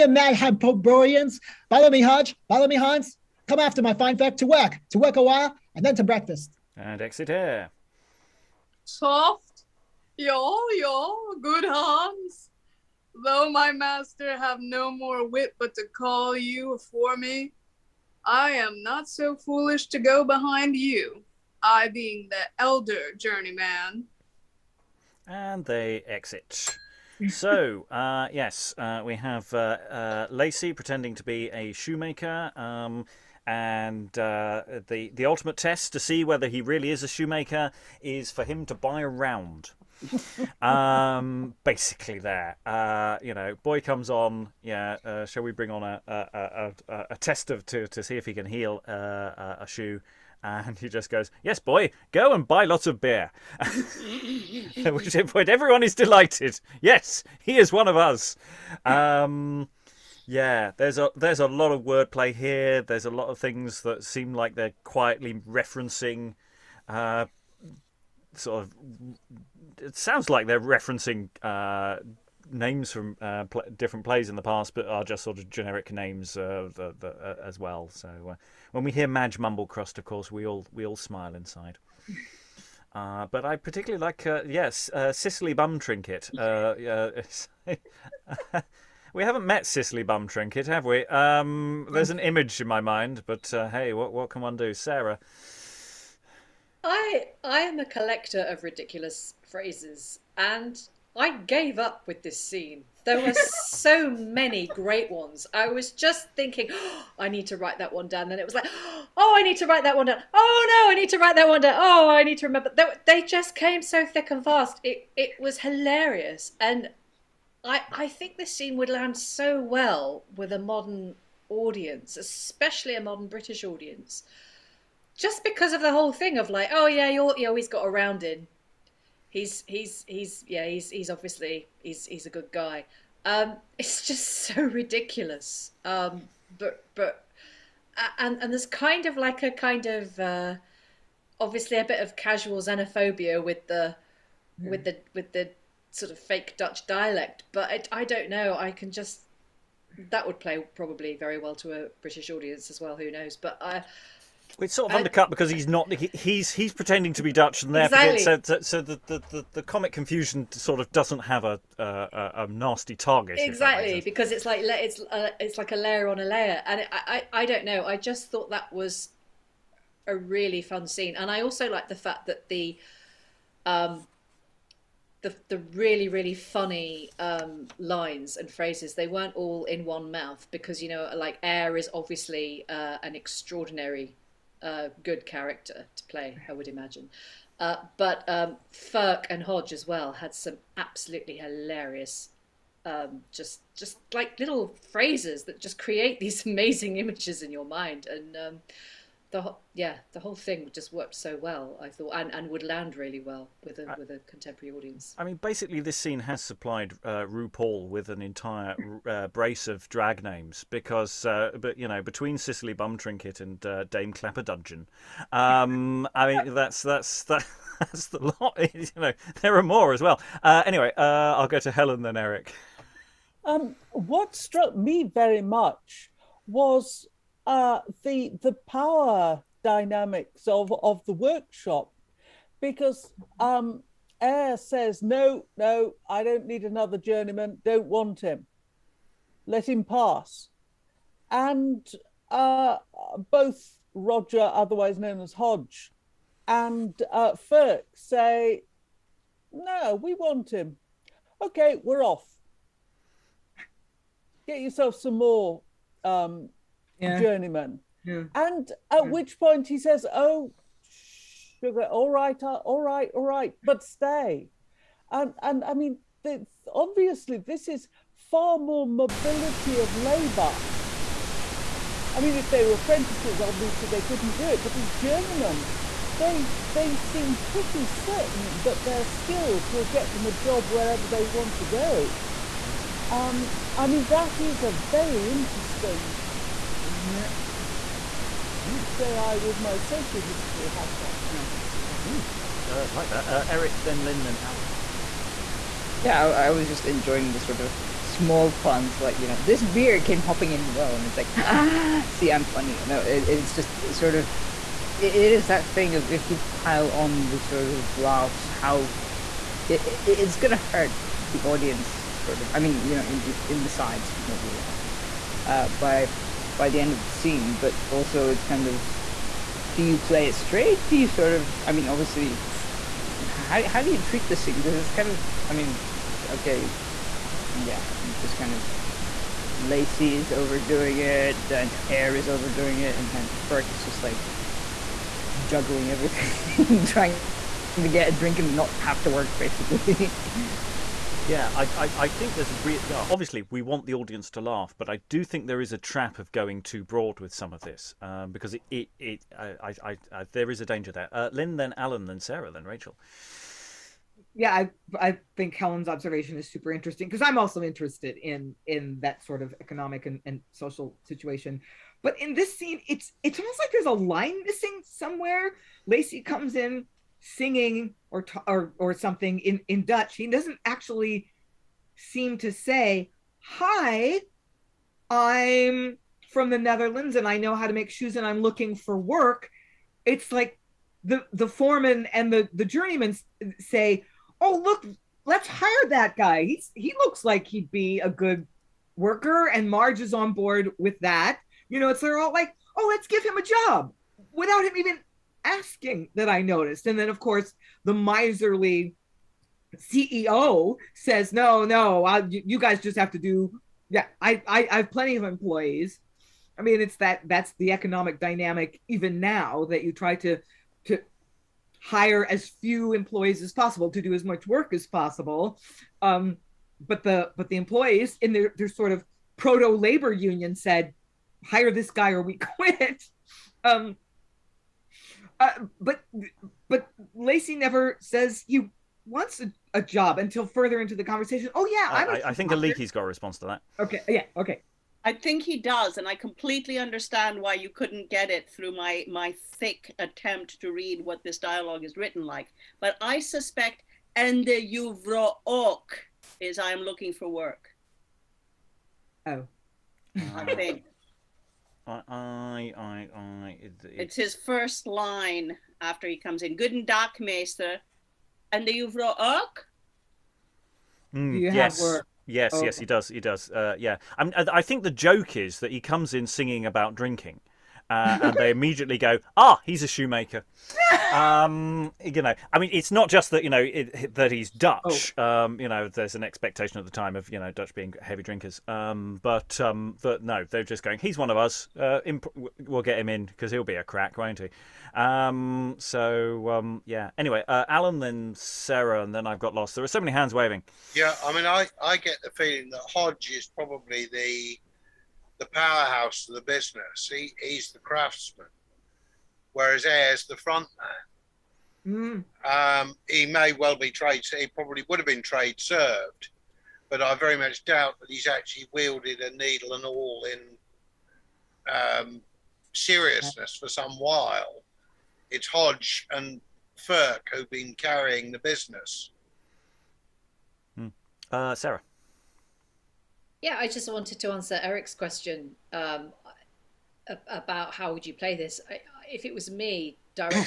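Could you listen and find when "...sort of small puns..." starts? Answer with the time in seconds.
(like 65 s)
297 s.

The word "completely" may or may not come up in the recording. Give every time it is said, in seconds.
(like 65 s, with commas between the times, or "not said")
436 s.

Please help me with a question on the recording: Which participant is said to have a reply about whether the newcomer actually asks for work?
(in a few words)
Aliki.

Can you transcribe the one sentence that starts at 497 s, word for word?
He, he's the craftsman, whereas Eyre's the front man.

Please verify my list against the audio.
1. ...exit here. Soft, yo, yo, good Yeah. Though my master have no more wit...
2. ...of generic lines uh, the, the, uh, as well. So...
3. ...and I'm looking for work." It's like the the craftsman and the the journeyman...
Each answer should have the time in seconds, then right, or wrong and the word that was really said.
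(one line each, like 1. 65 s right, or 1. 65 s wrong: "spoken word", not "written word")
1. 7 s wrong: "Hans", not "Yeah"
2. 75 s wrong: "names", not "lines"
3. 378 s wrong: "foreman", not "craftsman".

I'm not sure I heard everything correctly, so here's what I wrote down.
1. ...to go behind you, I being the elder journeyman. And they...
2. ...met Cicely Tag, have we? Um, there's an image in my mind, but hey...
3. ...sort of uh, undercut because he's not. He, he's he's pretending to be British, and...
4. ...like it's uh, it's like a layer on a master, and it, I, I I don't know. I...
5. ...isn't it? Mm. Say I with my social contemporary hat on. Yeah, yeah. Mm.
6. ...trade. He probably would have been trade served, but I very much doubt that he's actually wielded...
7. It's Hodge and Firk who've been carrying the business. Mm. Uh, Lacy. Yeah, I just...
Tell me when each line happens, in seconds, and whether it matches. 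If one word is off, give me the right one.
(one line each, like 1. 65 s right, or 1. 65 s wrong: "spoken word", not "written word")
1. 19 s right
2. 89 s wrong: "Bumtrinket", not "Tag"
3. 154 s wrong: "Dutch", not "British"
4. 164 s wrong: "layer", not "master"
5. 286 s wrong: "history", not "contemporary"
6. 503 s right
7. 515 s wrong: "Sarah", not "Lacy".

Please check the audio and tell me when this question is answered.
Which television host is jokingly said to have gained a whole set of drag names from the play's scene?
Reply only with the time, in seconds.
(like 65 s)
207 s.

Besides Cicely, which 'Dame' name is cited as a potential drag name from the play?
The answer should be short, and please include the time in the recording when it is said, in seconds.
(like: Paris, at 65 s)
Dame Clapperdudgeon, at 213 s.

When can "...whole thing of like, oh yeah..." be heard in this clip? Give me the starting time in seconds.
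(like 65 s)
125 s.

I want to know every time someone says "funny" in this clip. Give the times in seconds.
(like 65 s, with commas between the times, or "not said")
176 s, 302 s.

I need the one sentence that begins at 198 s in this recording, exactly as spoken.
And um, the whole, yeah, the whole thing just worked so well.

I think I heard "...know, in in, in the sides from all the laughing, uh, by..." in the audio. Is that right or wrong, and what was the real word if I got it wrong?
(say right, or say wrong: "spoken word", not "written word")
right.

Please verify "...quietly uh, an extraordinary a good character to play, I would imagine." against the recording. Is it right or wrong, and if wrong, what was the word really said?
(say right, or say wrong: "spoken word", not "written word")
wrong: "obviously", not "quietly".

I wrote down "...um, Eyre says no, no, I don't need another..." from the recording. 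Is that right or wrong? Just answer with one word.
right.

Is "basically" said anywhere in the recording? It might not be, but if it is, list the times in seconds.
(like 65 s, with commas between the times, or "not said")
41 s, 205 s, 339 s.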